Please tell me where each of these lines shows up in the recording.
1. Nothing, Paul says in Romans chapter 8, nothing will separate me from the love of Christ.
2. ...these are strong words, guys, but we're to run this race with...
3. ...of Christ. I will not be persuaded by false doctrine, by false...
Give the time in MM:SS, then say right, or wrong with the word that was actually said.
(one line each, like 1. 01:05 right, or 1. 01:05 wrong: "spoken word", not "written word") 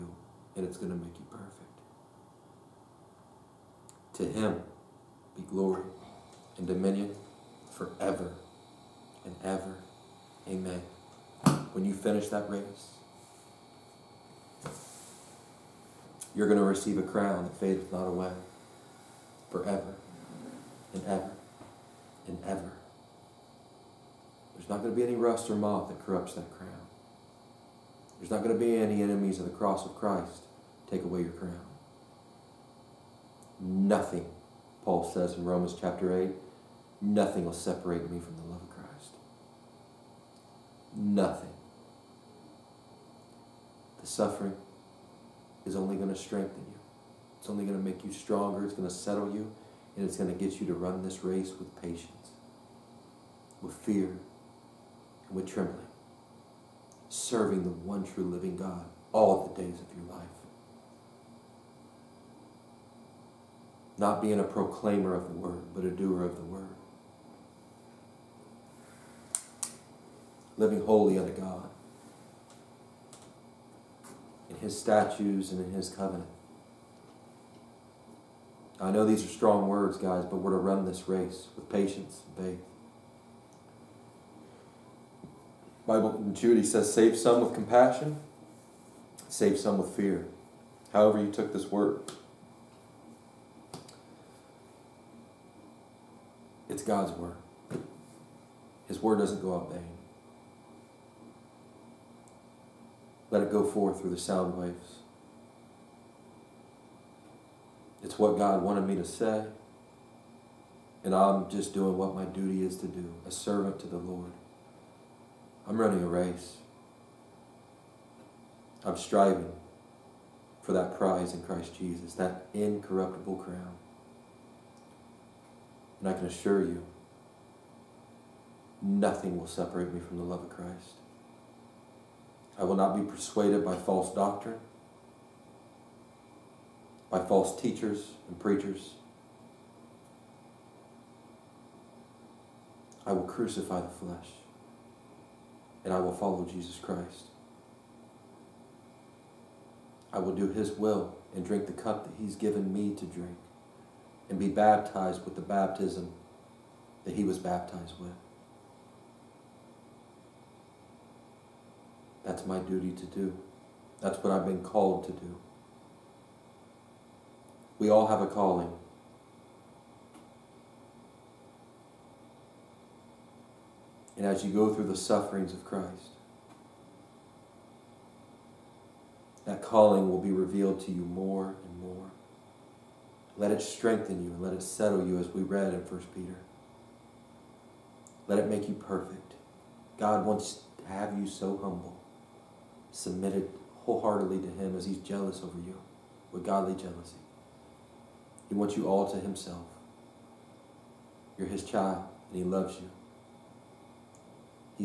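1. 00:33 right
2. 01:19 right
3. 02:10 right.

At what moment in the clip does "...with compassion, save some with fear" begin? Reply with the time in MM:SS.
01:27.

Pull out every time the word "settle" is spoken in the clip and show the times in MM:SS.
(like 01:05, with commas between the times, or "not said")
00:48, 03:04.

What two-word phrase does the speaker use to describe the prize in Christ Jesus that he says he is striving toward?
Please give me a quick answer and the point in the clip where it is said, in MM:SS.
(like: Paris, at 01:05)
incorruptible crown, at 02:02.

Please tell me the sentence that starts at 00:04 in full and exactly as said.
To him be glory and dominion forever and ever.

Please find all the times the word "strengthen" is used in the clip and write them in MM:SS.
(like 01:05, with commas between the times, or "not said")
00:46, 03:03.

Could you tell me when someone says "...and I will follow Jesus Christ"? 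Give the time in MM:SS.
02:25.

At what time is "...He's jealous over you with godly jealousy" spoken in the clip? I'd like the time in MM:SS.
03:14.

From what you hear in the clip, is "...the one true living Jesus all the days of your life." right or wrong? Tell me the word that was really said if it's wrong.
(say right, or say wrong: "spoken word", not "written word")
wrong: "God", not "Jesus".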